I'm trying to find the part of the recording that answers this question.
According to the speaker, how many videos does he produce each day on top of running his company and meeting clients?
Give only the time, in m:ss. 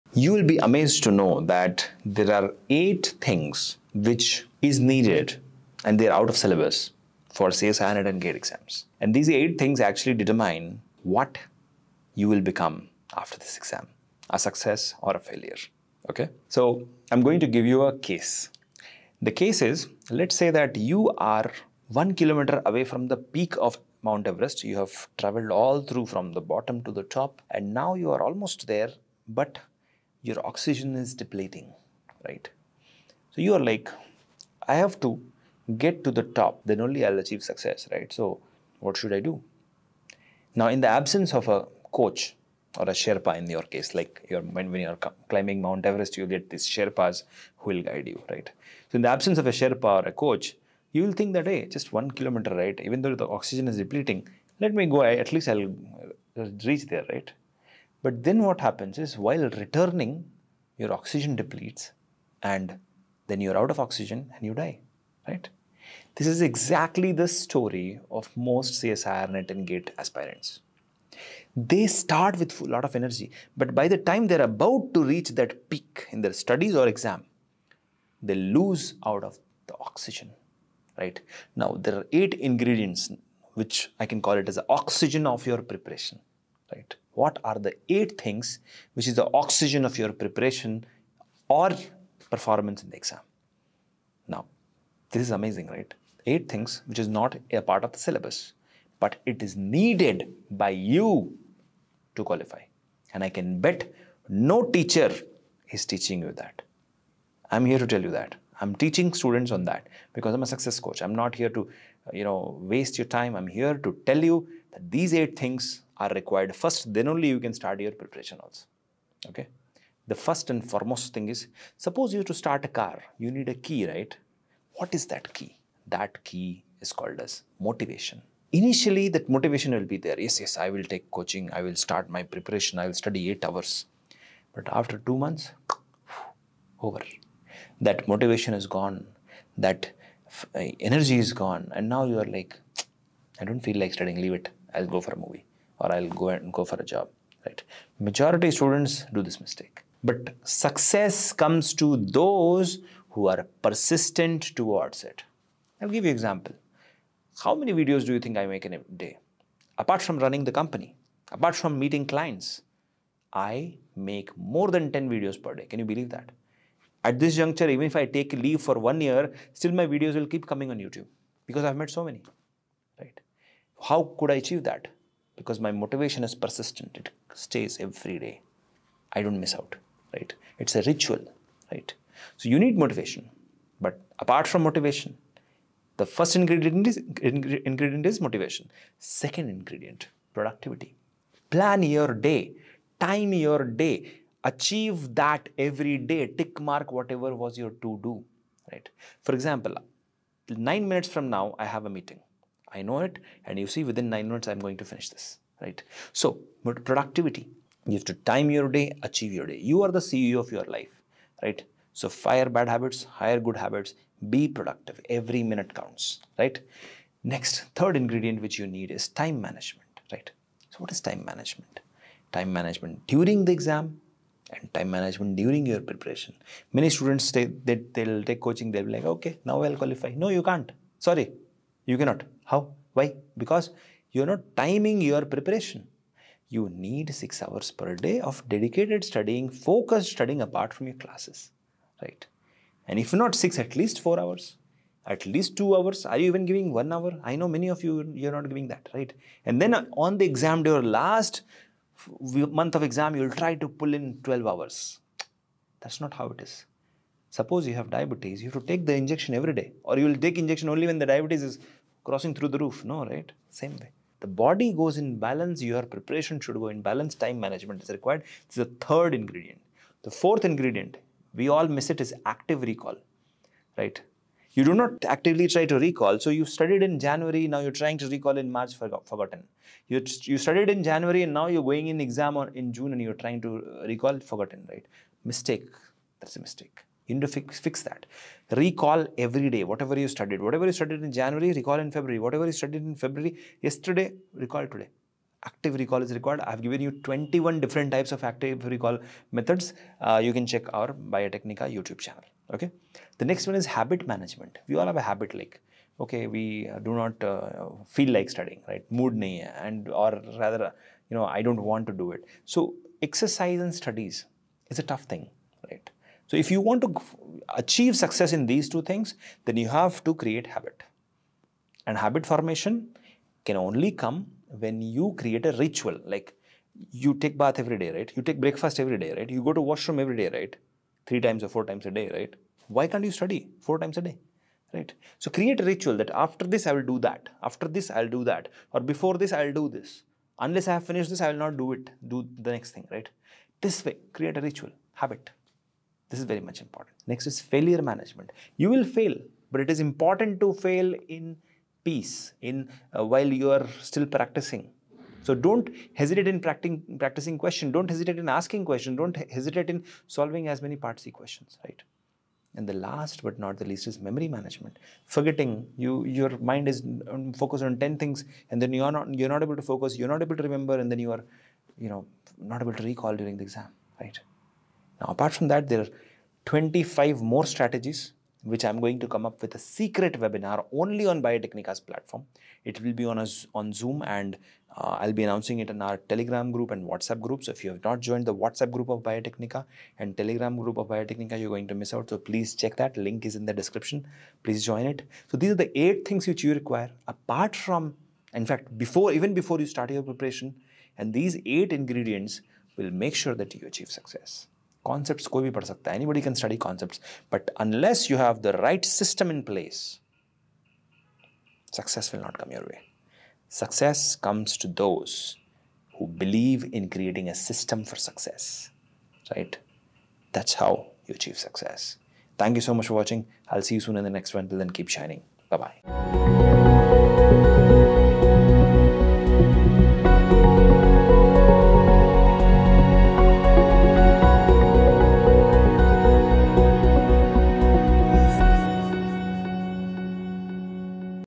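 2:44.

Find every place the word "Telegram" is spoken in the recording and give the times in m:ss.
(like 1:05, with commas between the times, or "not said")
6:25, 6:30.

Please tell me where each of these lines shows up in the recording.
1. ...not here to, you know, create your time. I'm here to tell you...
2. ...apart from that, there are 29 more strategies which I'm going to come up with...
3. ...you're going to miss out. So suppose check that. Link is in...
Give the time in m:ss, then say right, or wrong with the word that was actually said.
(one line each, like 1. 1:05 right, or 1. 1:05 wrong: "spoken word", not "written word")
1. 1:51 wrong: "waste", not "create"
2. 6:15 wrong: "25", not "29"
3. 6:31 wrong: "please", not "suppose".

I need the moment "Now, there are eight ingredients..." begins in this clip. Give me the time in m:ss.
1:21.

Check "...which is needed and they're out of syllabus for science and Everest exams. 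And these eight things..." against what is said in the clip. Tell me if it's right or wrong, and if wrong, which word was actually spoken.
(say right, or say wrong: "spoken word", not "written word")
wrong: "GATE", not "Everest".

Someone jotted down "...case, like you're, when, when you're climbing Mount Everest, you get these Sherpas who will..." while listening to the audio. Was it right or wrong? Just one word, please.
right.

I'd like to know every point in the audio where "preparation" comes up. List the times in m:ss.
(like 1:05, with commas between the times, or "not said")
1:25, 1:30, 1:58, 2:12, 3:45, 3:55, 4:25, 6:40.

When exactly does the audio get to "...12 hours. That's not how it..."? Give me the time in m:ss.
4:14.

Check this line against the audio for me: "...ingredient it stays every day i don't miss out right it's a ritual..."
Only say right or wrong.
wrong.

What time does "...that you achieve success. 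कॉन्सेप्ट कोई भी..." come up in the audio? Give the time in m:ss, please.
6:43.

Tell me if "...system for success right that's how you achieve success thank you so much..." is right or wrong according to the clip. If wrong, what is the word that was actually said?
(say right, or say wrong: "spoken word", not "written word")
right.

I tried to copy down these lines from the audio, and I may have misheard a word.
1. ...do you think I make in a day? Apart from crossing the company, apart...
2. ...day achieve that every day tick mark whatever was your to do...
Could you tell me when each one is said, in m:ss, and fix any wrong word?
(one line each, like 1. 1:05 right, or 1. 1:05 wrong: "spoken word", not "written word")
1. 2:38 wrong: "running", not "crossing"
2. 3:13 right.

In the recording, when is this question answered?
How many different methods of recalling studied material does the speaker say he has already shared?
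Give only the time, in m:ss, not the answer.
4:56.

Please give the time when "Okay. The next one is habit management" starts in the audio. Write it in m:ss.
5:02.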